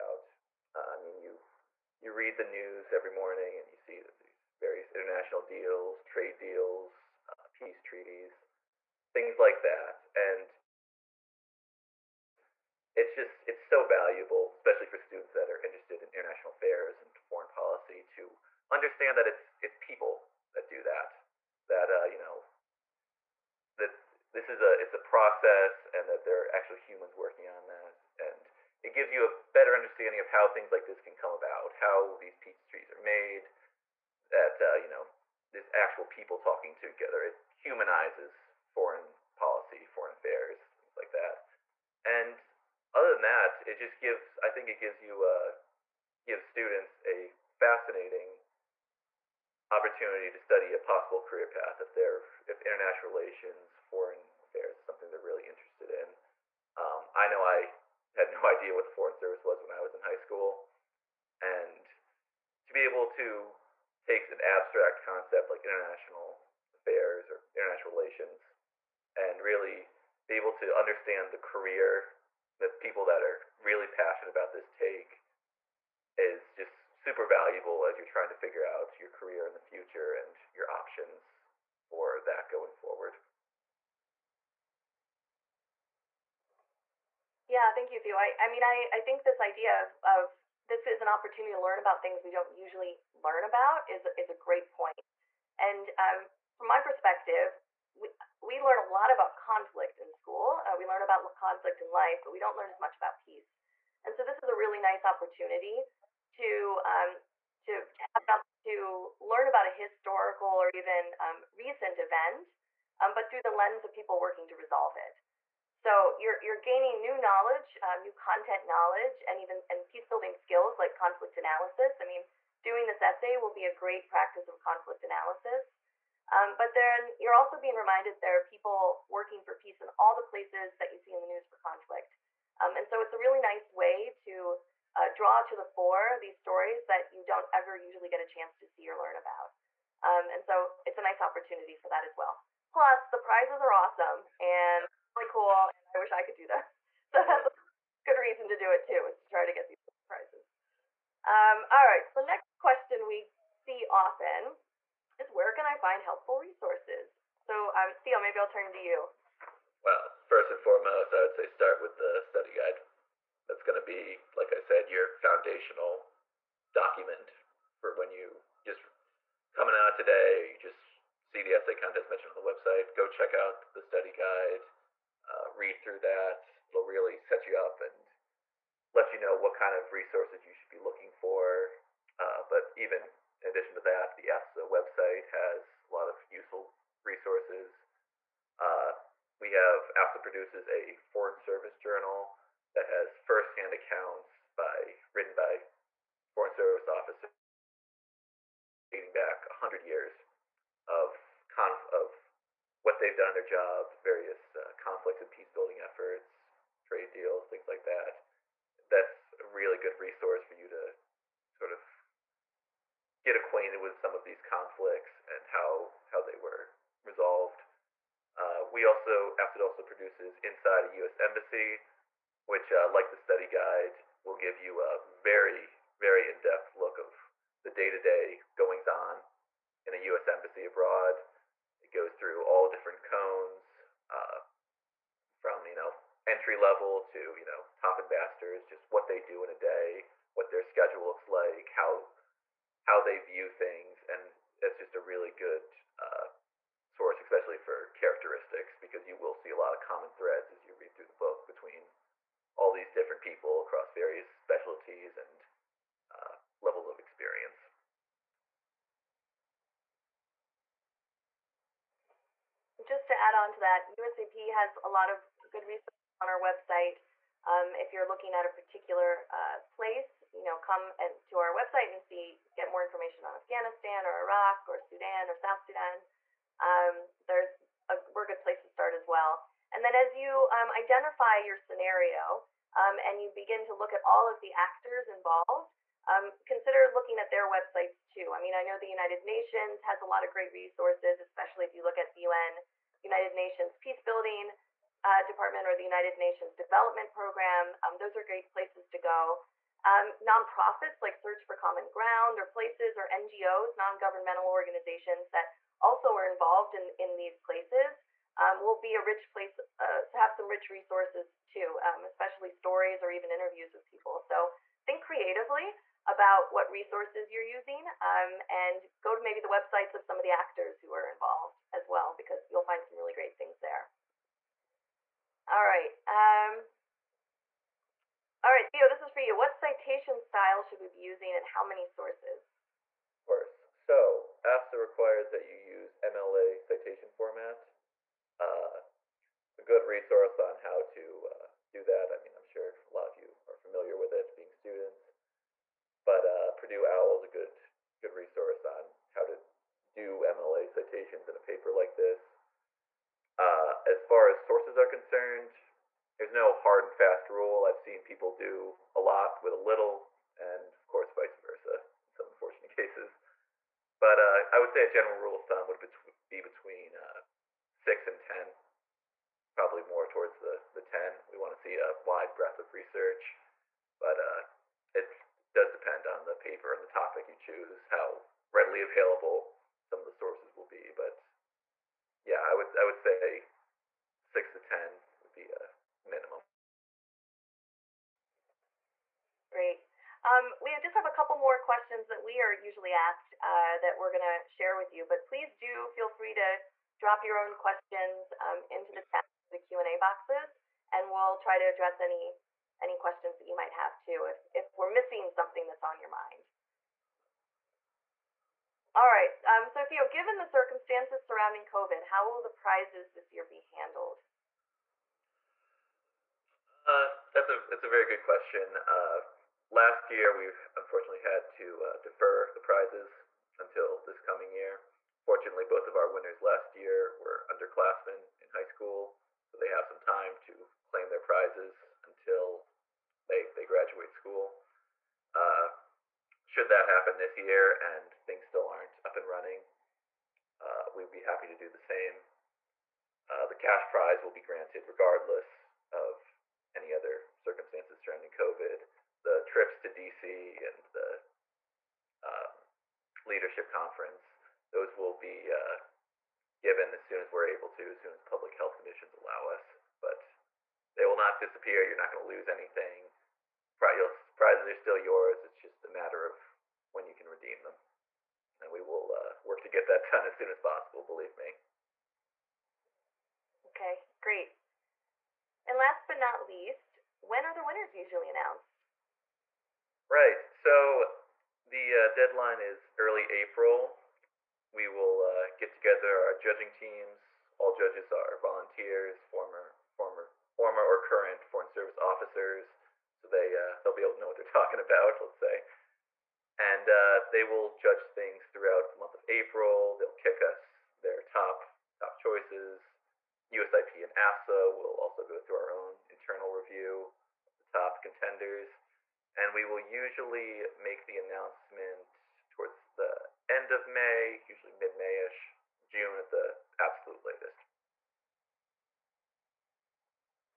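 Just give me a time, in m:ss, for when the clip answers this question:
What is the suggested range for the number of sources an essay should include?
6:07.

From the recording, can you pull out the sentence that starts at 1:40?
Uh, we learn about conflict in life, but we don't learn as much about peace.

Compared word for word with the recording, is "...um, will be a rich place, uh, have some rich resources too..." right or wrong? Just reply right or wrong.
right.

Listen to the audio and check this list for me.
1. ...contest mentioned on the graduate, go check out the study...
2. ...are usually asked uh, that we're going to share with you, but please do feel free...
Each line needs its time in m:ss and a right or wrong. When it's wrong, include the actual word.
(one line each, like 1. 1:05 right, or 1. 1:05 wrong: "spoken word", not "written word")
1. 2:51 wrong: "website", not "graduate"
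2. 6:32 right.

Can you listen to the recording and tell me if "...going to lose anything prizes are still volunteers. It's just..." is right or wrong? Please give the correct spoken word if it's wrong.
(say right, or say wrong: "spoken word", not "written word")
wrong: "yours", not "volunteers".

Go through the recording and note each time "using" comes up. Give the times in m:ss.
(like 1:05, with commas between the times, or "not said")
5:17, 5:30.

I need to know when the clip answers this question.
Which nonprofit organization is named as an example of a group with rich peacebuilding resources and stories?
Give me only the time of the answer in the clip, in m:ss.
5:01.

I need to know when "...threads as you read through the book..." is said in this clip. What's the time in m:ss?
4:10.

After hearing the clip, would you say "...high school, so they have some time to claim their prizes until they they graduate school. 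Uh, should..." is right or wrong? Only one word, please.
right.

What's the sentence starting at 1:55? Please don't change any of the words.
So you're, you're gaining new knowledge, um, new content knowledge, and even and peace building skills like conflict analysis.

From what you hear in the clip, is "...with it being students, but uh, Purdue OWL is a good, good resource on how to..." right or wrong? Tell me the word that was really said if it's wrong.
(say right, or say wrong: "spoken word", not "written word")
right.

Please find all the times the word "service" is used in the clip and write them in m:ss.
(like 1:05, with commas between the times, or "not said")
0:59, 3:11, 3:16, 8:11.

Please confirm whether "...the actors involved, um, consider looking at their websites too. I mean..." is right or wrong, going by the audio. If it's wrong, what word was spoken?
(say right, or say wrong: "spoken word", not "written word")
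right.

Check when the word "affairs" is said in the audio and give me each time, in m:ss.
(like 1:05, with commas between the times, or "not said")
0:16, 0:40, 0:54, 1:06.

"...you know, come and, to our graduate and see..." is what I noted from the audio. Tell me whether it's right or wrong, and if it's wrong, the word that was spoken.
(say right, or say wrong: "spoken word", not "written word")
wrong: "website", not "graduate".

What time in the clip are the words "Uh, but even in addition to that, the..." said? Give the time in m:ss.
3:02.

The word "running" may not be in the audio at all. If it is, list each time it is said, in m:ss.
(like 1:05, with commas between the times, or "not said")
7:19.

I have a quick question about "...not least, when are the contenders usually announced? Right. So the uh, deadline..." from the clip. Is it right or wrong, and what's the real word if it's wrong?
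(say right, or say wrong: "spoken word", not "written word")
wrong: "winners", not "contenders".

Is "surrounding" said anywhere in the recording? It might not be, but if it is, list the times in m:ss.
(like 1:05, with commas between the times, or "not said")
6:51, 7:28.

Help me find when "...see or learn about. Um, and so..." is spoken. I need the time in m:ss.
2:18.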